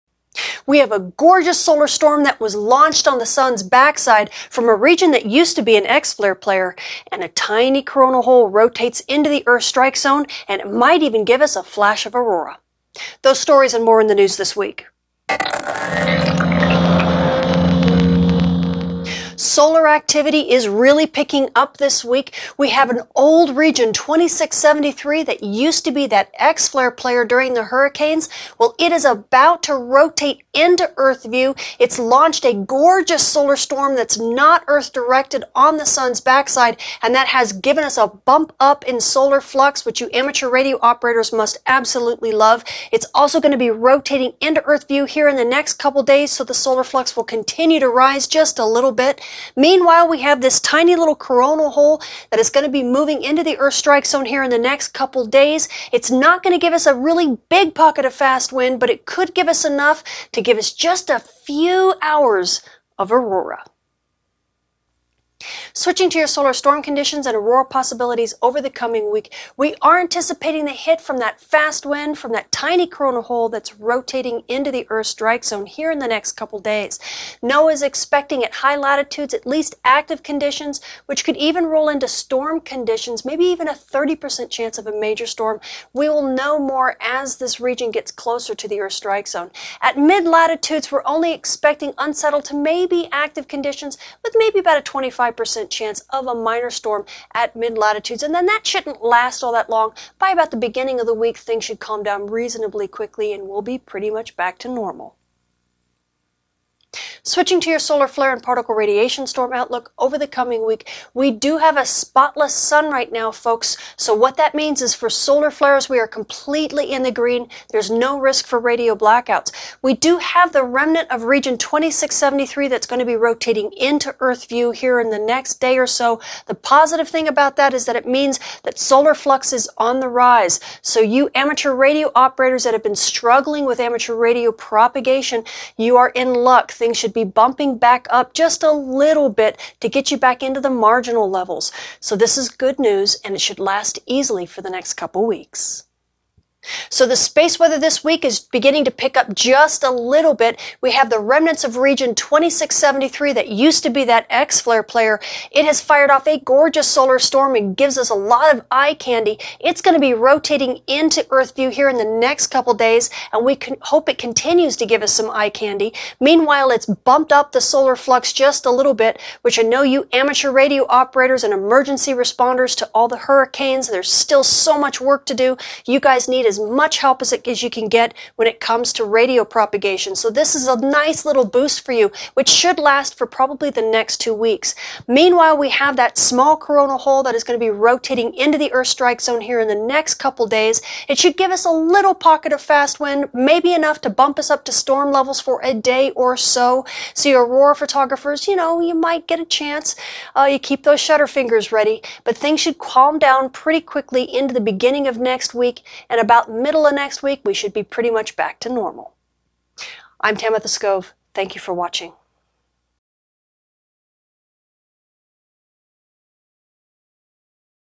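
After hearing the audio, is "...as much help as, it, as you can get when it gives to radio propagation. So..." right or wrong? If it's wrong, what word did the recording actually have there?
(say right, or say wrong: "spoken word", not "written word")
wrong: "comes", not "gives".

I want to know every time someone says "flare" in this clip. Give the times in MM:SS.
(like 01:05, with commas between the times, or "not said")
00:05, 00:26, 01:48, 01:55, 02:34.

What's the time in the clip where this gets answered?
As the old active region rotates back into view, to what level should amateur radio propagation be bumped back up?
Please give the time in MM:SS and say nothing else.
02:20.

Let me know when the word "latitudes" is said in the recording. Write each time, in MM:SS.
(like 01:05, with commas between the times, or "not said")
01:18, 01:30, 01:37.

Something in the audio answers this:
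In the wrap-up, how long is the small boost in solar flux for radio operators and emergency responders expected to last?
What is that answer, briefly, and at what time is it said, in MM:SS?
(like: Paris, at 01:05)
two weeks, at 03:04.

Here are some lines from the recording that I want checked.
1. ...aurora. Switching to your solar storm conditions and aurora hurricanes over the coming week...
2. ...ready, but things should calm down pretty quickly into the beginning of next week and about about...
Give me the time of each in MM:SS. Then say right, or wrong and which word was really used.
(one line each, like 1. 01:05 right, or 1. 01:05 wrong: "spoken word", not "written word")
1. 01:03 wrong: "possibilities", not "hurricanes"
2. 03:21 right.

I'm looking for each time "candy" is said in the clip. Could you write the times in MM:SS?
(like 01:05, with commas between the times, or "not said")
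02:38, 02:45.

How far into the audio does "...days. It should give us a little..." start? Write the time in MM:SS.
03:10.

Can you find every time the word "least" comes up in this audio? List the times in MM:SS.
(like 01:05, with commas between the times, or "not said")
01:19.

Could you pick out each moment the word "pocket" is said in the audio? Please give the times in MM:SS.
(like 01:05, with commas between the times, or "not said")
00:57, 03:12.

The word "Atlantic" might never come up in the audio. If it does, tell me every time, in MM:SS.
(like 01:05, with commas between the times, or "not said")
not said.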